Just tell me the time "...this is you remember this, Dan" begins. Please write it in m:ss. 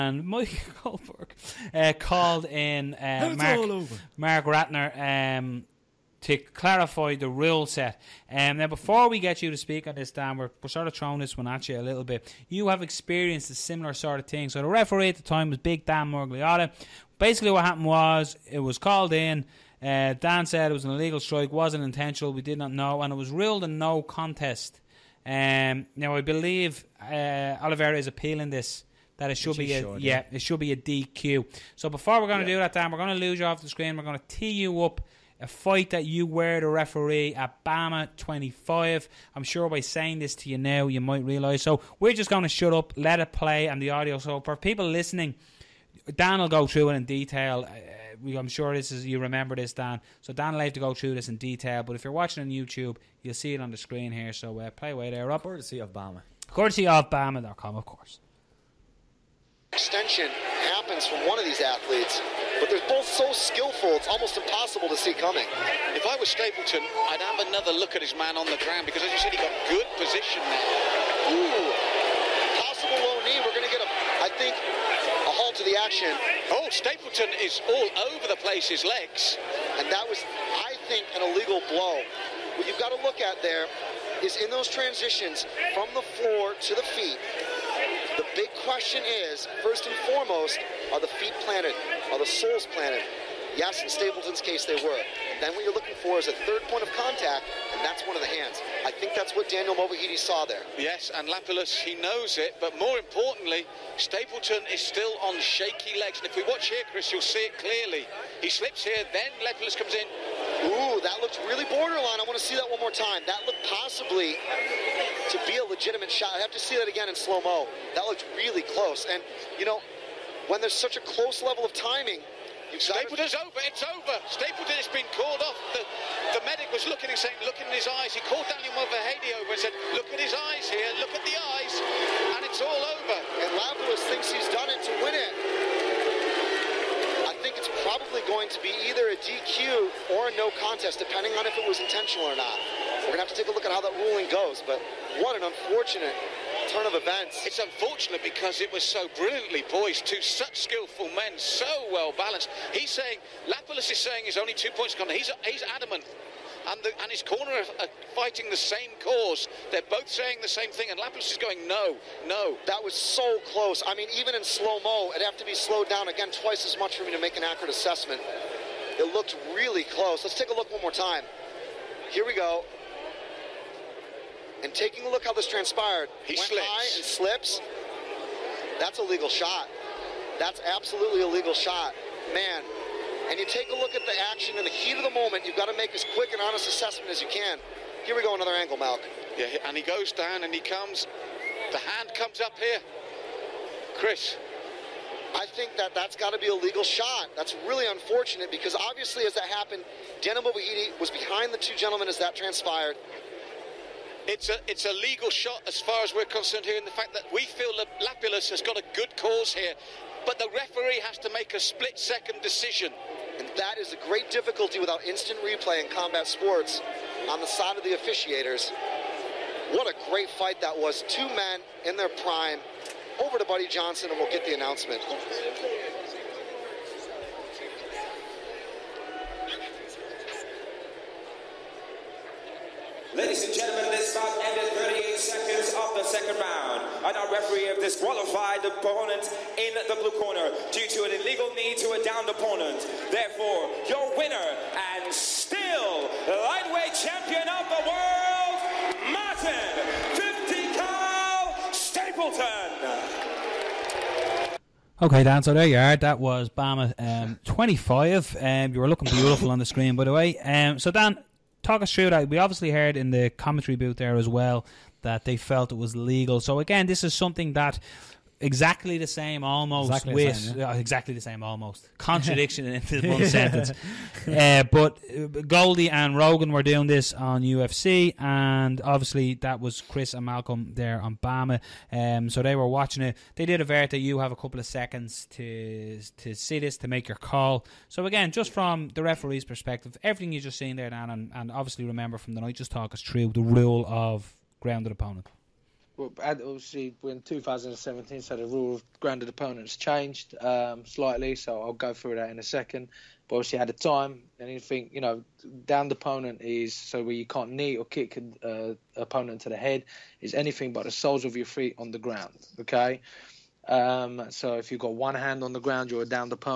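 0:48.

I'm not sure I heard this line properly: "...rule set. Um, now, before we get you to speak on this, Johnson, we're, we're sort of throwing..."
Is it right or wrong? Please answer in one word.
wrong.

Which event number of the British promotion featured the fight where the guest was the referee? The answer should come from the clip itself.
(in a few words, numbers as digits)
BAMMA 25.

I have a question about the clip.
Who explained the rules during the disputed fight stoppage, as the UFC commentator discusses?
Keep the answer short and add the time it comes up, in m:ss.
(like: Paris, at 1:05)
Mark Ratner, at 0:04.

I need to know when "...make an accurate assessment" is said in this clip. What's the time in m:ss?
2:47.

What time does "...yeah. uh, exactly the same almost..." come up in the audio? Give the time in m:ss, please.
4:30.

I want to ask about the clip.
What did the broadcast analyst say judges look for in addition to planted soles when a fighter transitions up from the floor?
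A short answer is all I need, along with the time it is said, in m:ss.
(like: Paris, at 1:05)
a third point of contact, at 1:36.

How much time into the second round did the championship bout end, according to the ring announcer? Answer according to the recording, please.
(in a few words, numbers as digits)
38 seconds.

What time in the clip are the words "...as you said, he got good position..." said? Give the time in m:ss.
1:09.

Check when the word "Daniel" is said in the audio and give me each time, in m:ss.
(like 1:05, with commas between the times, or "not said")
1:39, 2:08.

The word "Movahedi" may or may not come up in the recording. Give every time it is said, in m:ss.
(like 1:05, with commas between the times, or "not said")
1:39, 2:08.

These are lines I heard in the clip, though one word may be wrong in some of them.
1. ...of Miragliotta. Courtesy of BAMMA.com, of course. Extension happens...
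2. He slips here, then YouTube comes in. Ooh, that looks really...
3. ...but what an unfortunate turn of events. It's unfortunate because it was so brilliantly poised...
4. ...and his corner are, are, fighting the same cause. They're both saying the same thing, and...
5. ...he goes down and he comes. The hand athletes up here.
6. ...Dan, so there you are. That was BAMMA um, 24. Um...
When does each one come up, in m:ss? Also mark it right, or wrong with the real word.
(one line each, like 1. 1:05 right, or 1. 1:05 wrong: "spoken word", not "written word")
1. 0:55 wrong: "BAMMA", not "Miragliotta"
2. 1:48 wrong: "Lapilus", not "YouTube"
3. 2:24 right
4. 2:37 right
5. 3:09 wrong: "comes", not "athletes"
6. 4:15 wrong: "25", not "24".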